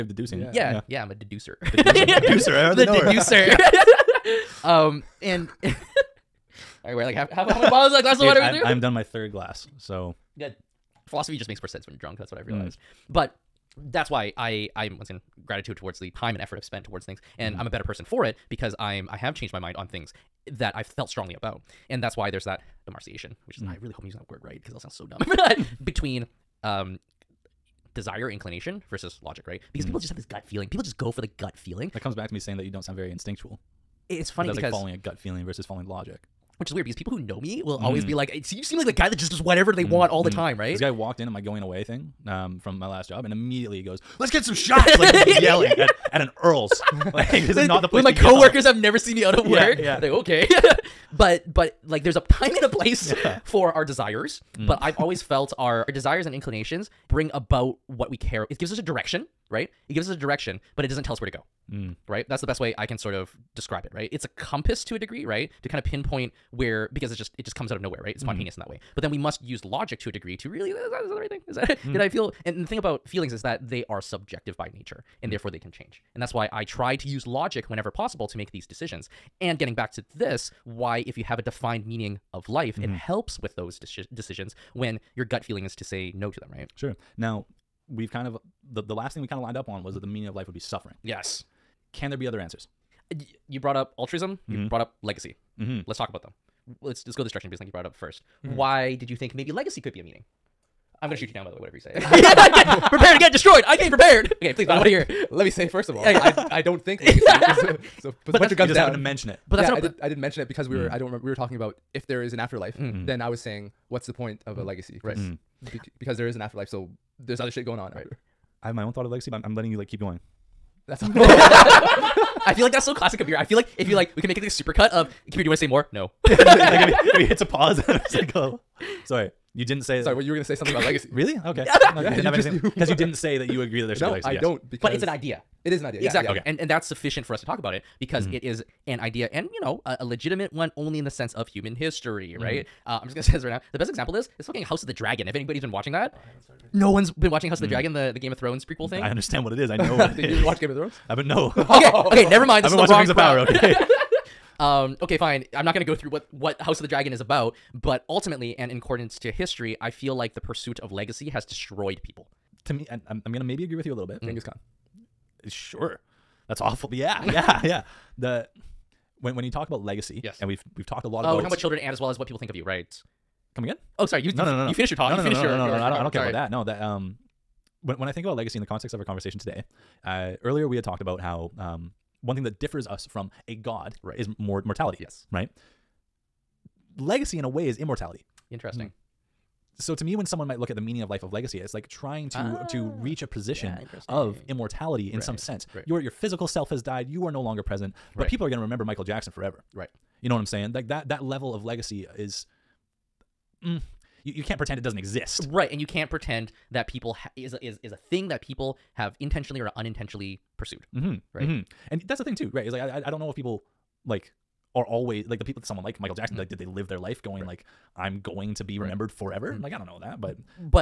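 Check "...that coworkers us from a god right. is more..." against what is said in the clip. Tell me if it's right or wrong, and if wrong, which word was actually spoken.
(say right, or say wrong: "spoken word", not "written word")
wrong: "differs", not "coworkers".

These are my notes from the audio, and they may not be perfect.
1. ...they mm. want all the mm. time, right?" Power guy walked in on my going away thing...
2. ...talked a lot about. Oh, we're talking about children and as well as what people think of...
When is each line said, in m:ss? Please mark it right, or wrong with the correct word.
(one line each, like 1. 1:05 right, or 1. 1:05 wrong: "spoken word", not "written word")
1. 0:39 wrong: "This", not "Power"
2. 2:50 right.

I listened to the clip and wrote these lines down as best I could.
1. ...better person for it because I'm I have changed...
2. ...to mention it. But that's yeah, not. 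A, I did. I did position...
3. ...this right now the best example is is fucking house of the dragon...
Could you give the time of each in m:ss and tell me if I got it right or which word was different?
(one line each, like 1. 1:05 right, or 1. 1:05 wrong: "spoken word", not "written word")
1. 0:17 right
2. 1:48 wrong: "mention", not "position"
3. 2:23 right.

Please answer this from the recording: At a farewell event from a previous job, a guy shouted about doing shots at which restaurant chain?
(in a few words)
Earl's.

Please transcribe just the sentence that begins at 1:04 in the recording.
It's a compass to a degree, right?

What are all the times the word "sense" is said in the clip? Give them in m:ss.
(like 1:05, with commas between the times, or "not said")
0:11, 2:21, 3:15.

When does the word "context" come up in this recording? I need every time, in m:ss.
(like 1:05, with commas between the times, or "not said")
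2:58.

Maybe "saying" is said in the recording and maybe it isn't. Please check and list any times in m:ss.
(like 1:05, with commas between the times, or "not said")
0:32, 1:53, 3:20.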